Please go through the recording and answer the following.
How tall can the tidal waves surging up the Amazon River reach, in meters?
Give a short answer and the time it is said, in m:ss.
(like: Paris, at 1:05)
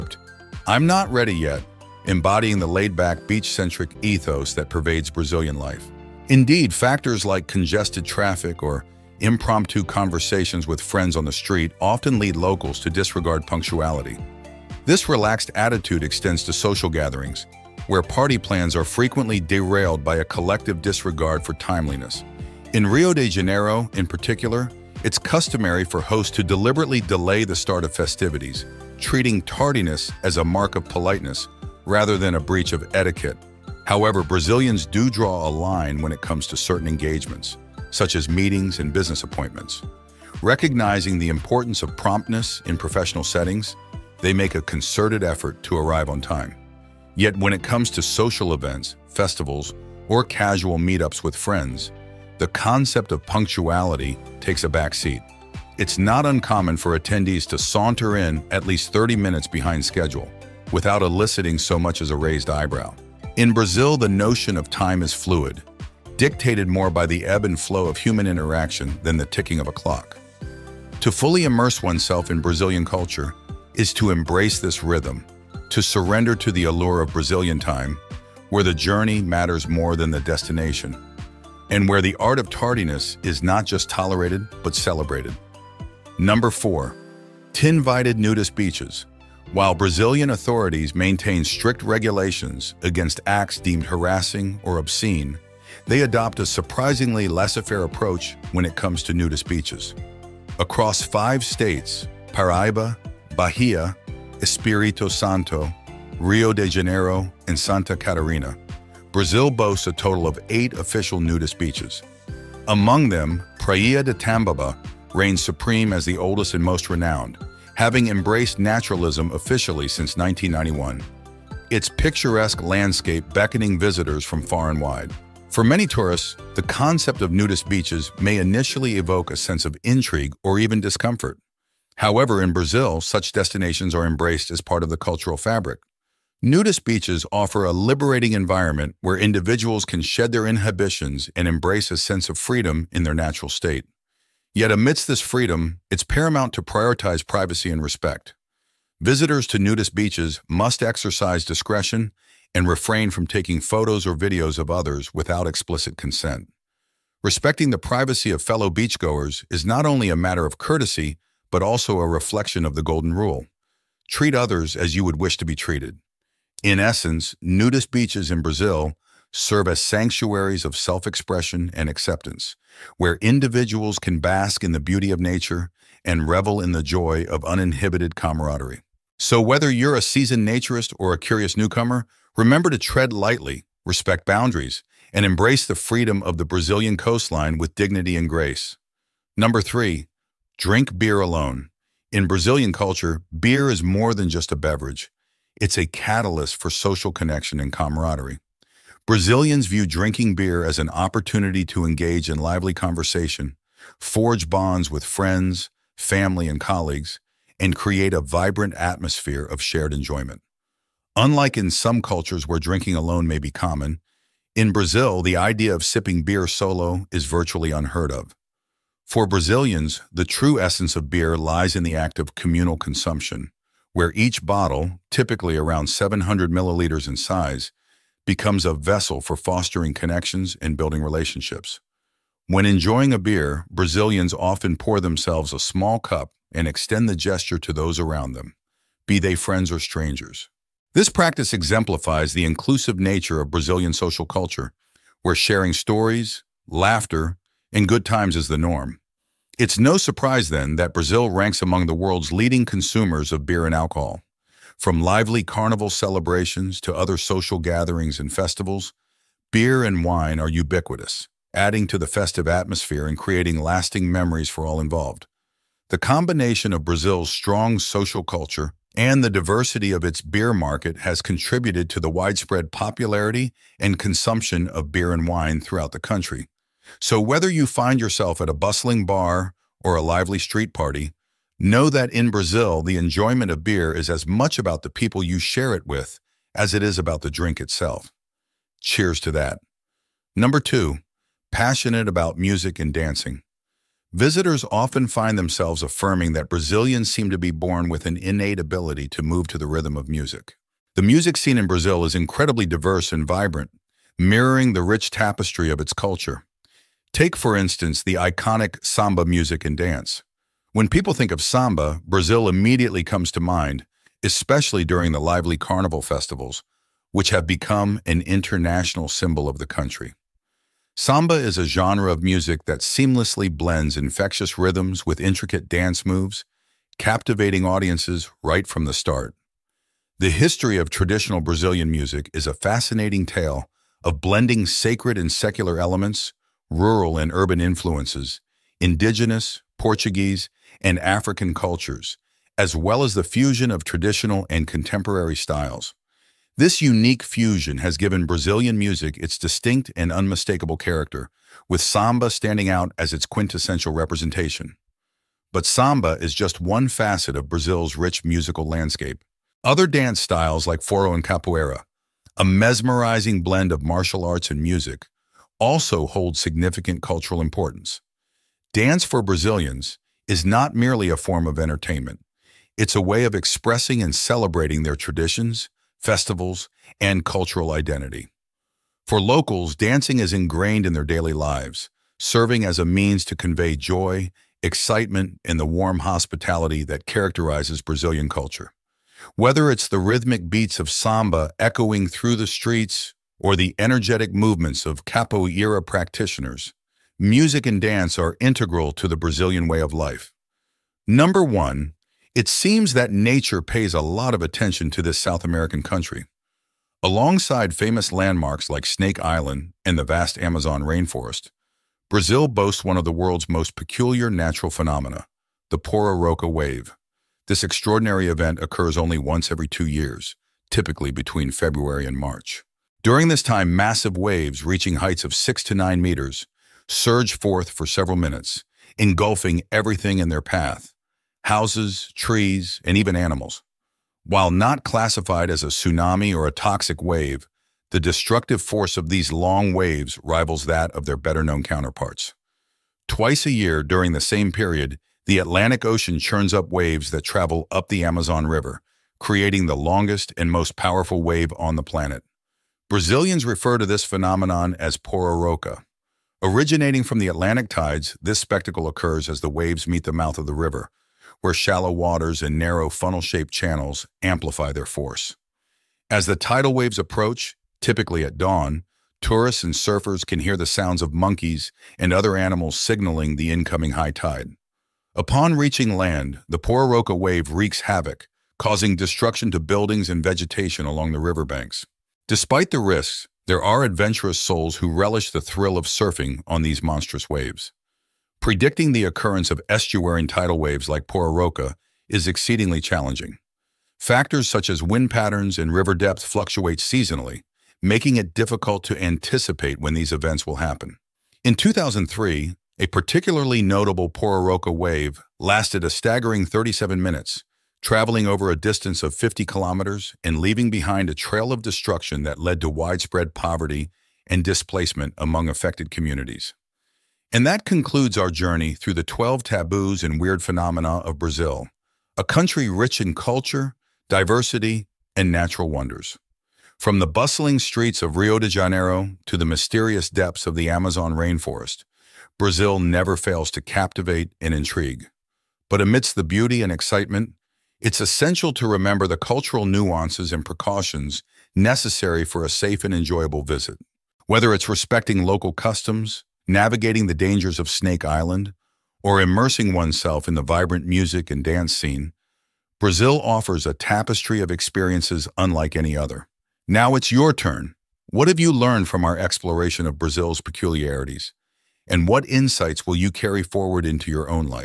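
6 to 9 meters, at 7:05.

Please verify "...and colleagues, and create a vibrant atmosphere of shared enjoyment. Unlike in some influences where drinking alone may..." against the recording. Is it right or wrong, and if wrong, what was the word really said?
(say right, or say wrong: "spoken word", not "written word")
wrong: "cultures", not "influences".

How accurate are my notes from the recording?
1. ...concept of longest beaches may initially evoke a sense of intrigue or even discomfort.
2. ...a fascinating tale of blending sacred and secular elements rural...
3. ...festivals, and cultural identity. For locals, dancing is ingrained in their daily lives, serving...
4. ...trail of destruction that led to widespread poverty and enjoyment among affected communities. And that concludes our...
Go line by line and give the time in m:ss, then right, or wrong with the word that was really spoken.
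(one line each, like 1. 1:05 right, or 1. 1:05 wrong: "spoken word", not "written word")
1. 2:06 wrong: "nudist", not "longest"
2. 5:32 right
3. 6:16 right
4. 8:31 wrong: "displacement", not "enjoyment".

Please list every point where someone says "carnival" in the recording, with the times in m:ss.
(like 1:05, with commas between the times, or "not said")
4:15, 5:15.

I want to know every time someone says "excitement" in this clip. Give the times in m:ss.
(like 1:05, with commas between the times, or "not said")
6:24, 8:56.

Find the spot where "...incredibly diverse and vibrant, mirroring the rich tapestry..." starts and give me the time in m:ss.
5:02.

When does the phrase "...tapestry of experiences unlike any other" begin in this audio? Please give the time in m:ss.
9:13.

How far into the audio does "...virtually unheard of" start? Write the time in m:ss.
3:37.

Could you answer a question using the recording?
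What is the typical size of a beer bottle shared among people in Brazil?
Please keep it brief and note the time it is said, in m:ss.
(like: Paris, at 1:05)
700 milliliters, at 3:45.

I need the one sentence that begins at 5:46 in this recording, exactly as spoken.
This unique fusion has given Brazilian music its distinct and unmistakable character, with samba standing out as its quintessential representation.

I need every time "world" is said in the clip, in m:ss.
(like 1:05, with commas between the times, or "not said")
4:11, 6:53.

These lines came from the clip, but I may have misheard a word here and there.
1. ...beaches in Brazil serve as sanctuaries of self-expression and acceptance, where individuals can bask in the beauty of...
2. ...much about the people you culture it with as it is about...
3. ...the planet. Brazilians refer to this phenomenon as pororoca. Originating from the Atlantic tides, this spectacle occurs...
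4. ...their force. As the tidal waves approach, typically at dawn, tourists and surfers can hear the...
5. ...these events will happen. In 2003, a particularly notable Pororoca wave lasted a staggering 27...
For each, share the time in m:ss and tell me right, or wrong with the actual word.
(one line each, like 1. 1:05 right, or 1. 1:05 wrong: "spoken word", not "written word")
1. 2:47 right
2. 4:44 wrong: "share", not "culture"
3. 7:31 right
4. 7:44 right
5. 8:19 wrong: "37", not "27".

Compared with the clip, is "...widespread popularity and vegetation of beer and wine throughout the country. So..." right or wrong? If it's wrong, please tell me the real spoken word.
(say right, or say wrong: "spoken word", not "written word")
wrong: "consumption", not "vegetation".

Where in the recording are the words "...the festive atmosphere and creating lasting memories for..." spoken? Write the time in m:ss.
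4:21.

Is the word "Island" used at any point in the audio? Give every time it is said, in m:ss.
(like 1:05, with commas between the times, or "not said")
6:49, 9:08.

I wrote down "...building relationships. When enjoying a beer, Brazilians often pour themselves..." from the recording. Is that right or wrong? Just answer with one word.
right.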